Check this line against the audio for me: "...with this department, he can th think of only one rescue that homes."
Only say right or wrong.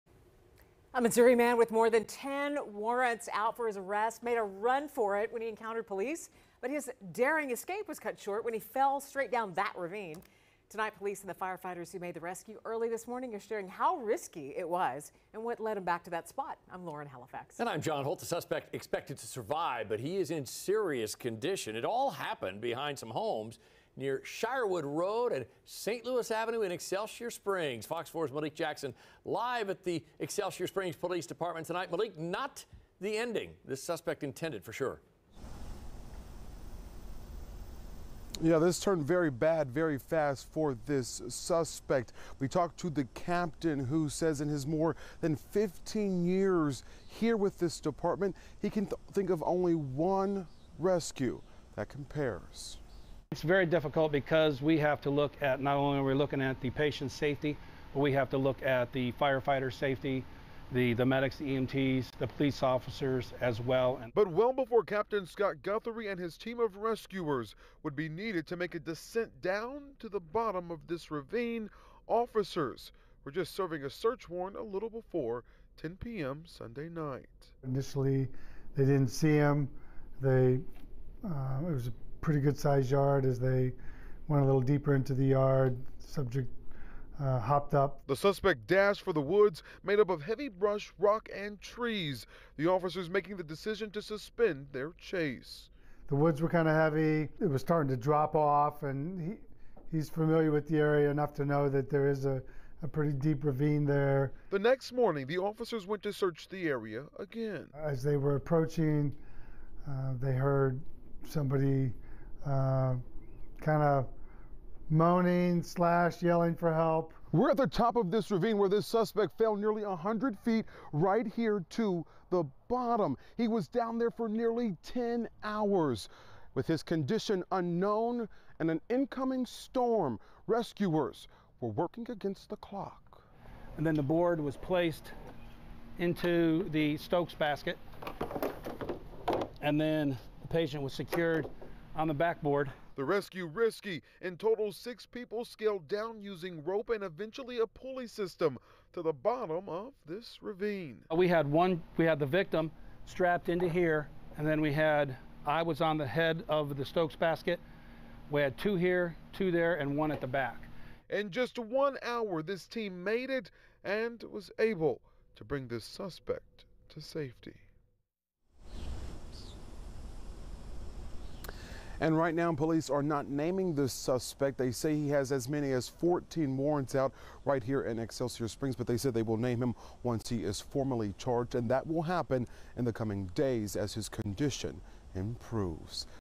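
wrong.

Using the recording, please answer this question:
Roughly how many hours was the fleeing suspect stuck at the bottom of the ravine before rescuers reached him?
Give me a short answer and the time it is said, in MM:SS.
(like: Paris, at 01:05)
10, at 02:04.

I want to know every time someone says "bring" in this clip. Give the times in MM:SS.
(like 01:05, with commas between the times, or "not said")
02:45.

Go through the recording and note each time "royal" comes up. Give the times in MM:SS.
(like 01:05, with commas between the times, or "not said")
not said.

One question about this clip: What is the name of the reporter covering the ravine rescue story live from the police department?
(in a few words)
Malik Jackson.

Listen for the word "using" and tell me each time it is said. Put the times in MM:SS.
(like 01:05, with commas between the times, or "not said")
02:26.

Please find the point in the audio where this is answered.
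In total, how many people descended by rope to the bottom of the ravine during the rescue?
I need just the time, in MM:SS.
02:24.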